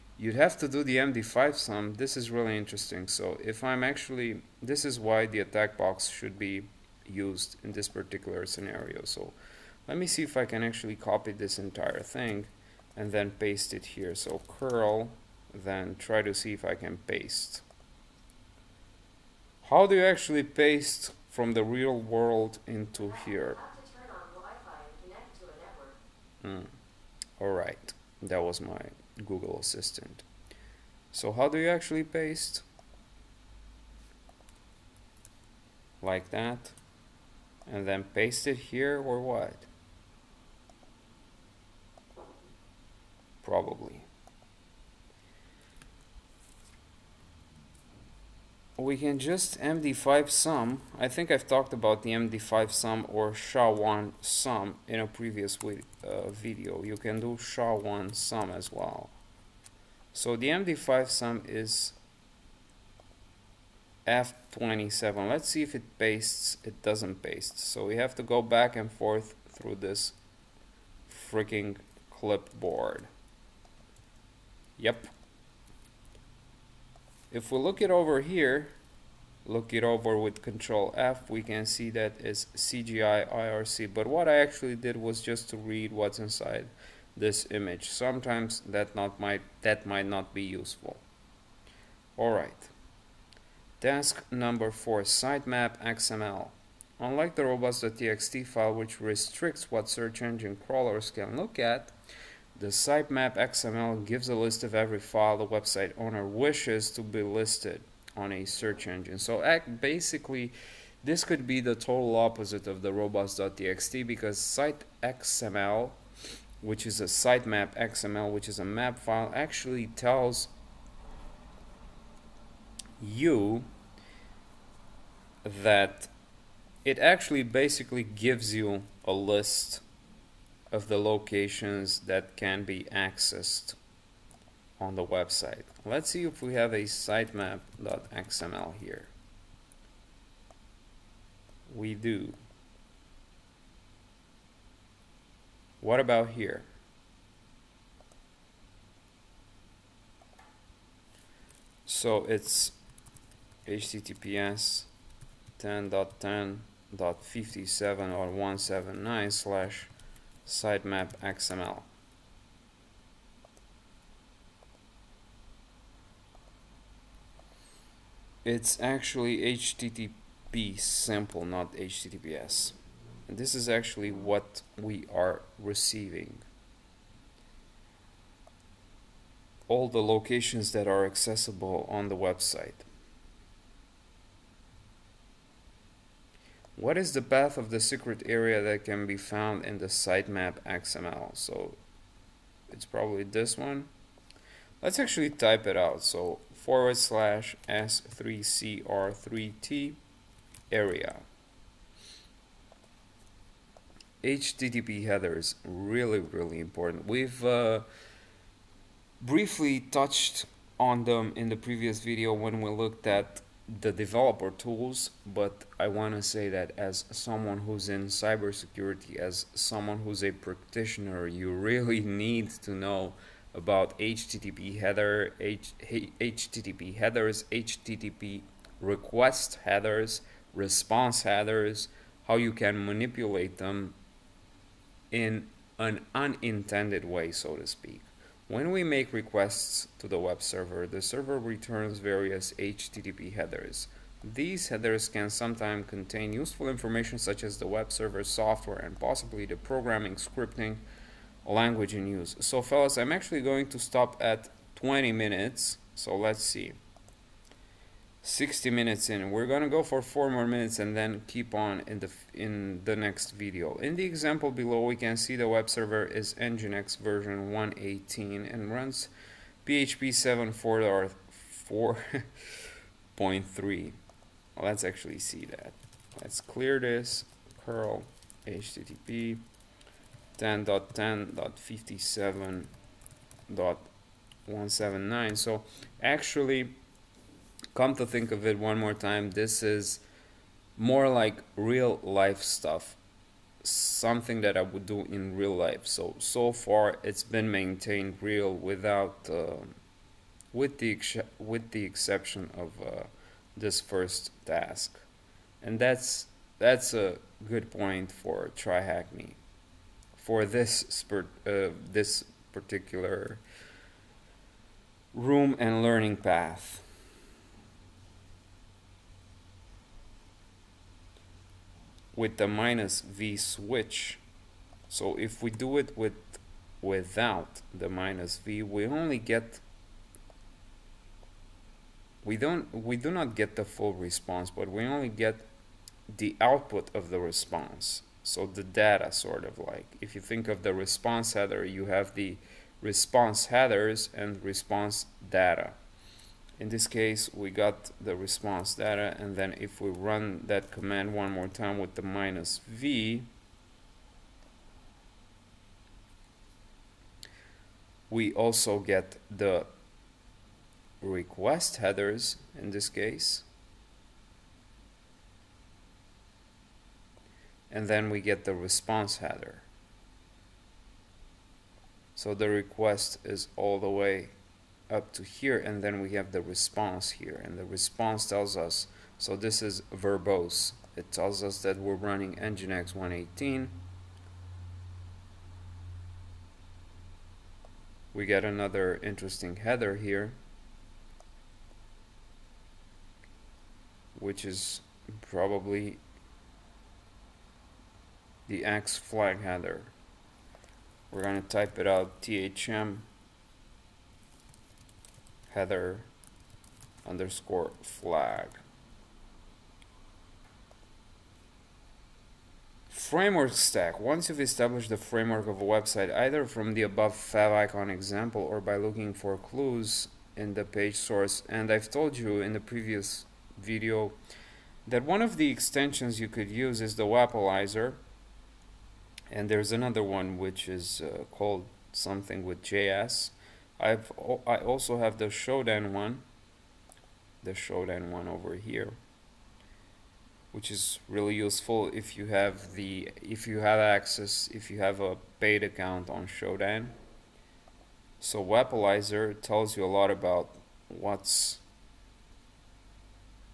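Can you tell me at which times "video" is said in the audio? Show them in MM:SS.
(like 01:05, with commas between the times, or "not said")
00:56, 03:32, 04:23, 07:03.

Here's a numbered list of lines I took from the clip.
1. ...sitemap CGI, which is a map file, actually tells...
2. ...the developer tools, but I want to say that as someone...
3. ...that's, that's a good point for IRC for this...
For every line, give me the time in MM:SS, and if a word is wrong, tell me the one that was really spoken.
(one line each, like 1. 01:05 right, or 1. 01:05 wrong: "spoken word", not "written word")
1. 01:57 wrong: "XML", not "CGI"
2. 03:33 right
3. 05:05 wrong: "TryHackMe", not "IRC".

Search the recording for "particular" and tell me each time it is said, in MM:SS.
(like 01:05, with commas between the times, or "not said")
00:07, 05:12.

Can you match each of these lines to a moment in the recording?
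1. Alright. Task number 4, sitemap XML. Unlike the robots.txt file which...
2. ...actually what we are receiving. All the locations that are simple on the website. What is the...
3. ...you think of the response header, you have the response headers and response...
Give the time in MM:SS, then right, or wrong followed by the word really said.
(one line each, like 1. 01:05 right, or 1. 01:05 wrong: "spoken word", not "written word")
1. 01:32 right
2. 02:53 wrong: "accessible", not "simple"
3. 05:40 right.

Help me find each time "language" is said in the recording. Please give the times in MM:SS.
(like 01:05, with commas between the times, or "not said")
04:11.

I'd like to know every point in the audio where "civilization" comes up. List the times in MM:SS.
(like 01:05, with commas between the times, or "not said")
not said.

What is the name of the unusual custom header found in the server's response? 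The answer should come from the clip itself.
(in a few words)
X flag.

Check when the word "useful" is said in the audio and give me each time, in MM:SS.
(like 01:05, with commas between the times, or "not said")
01:30, 04:06, 07:21.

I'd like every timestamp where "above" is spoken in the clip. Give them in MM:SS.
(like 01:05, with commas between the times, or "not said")
06:56.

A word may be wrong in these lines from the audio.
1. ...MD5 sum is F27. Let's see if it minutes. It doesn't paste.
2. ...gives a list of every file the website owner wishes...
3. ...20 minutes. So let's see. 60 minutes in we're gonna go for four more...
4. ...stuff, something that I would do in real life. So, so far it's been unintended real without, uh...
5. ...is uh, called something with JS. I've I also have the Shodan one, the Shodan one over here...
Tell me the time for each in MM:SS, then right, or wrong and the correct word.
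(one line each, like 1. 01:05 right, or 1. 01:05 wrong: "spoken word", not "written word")
1. 01:00 wrong: "pastes", not "minutes"
2. 01:44 right
3. 04:14 right
4. 04:52 wrong: "maintained", not "unintended"
5. 07:10 right.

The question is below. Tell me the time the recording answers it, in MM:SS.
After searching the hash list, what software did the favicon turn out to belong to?
01:22.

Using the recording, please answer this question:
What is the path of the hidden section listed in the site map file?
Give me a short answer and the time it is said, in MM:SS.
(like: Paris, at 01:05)
/s3cr3t-area, at 03:17.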